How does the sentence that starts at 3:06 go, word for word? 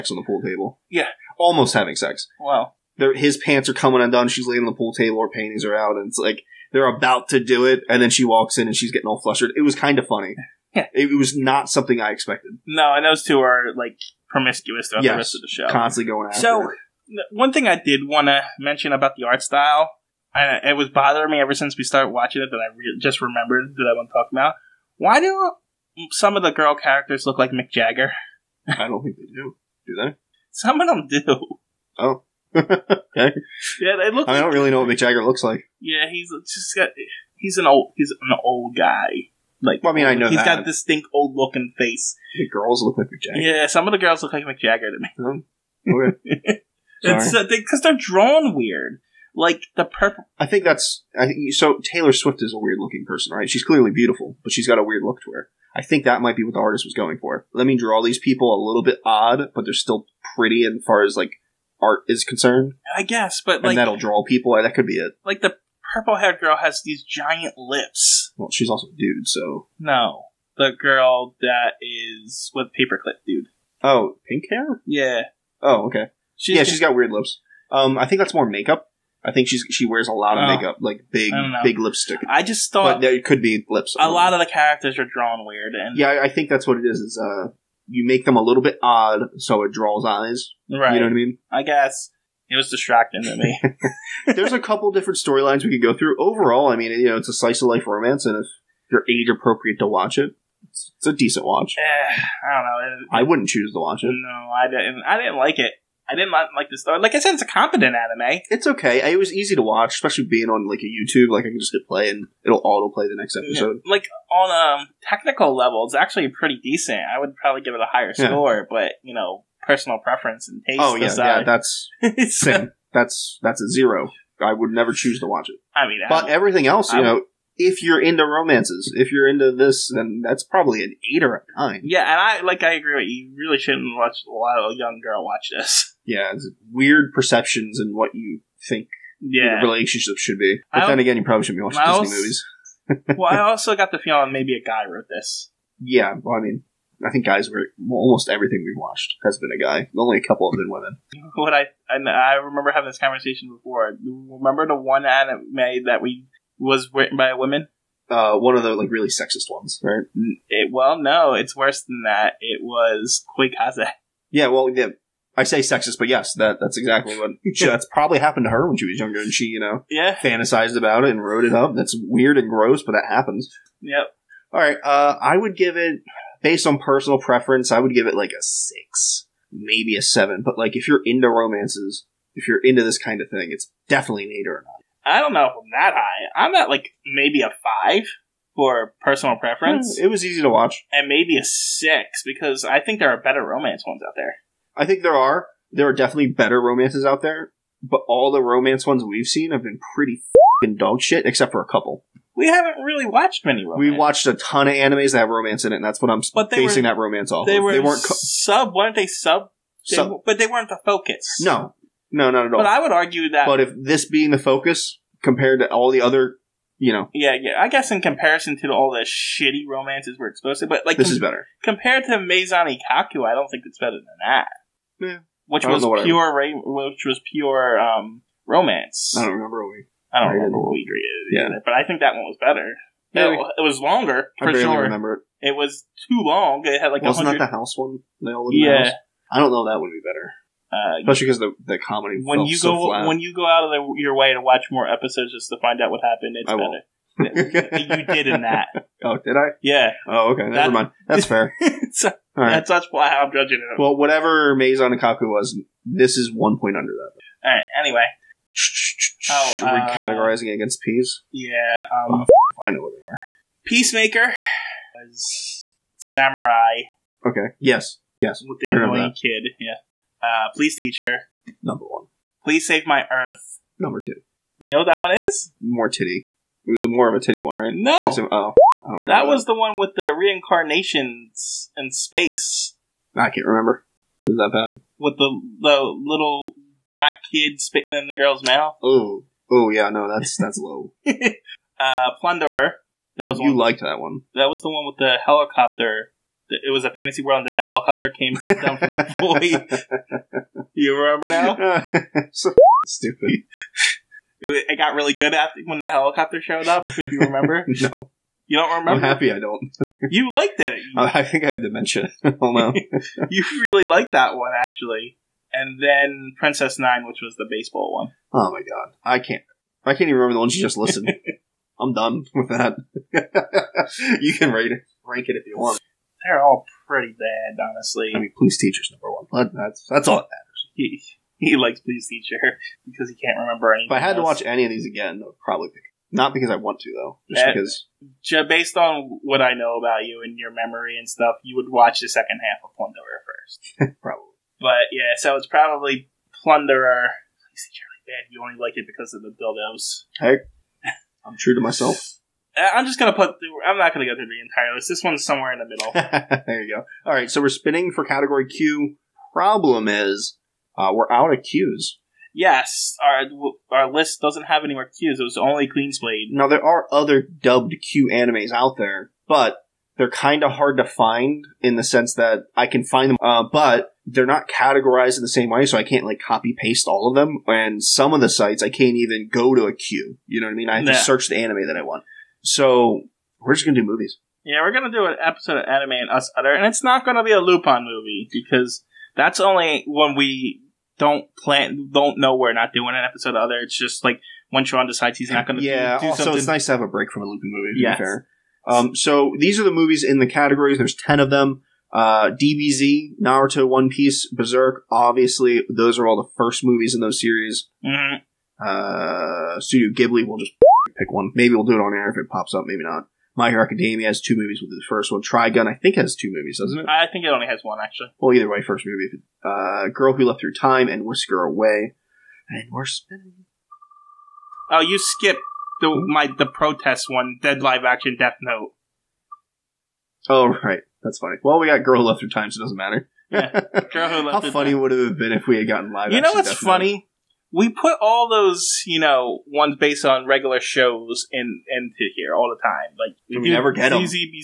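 I'm at like maybe a five for personal preference.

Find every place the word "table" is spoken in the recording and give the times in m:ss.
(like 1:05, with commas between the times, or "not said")
0:00, 0:04.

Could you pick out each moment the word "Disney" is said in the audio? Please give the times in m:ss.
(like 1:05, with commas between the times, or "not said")
2:22.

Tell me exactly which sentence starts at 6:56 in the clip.
I think it only has one, actually.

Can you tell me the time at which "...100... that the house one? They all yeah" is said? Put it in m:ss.
3:57.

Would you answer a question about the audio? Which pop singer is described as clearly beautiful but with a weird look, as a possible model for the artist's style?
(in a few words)
Taylor Swift.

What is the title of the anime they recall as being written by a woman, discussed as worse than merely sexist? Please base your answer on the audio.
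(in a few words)
Koi Kaze.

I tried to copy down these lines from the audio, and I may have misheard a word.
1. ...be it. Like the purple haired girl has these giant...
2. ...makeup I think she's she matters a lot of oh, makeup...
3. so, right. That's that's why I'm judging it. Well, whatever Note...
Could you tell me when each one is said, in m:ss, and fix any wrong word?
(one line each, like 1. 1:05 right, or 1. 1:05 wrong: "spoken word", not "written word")
1. 1:04 right
2. 1:18 wrong: "wears", not "matters"
3. 4:11 wrong: "Maison", not "Note".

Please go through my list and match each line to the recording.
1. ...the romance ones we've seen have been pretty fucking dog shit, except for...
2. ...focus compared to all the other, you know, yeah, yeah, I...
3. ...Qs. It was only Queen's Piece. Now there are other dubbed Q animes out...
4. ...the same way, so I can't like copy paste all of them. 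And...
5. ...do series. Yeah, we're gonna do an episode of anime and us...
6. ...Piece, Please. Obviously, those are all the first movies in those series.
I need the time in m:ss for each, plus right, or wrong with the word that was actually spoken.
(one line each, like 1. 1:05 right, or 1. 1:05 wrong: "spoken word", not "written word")
1. 3:18 right
2. 3:34 right
3. 6:04 wrong: "Blade", not "Piece"
4. 6:15 right
5. 6:23 wrong: "movies", not "series"
6. 6:43 wrong: "Berserk", not "Please".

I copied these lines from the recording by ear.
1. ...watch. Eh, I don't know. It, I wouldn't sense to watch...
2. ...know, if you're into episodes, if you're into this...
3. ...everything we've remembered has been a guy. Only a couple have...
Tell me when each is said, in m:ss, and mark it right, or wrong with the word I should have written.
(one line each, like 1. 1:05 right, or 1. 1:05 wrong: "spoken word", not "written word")
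1. 1:41 wrong: "choose", not "sense"
2. 2:07 wrong: "romances", not "episodes"
3. 2:28 wrong: "watched", not "remembered".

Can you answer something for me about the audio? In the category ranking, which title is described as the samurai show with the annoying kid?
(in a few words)
Peacemaker.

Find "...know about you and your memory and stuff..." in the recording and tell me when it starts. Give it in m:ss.
5:39.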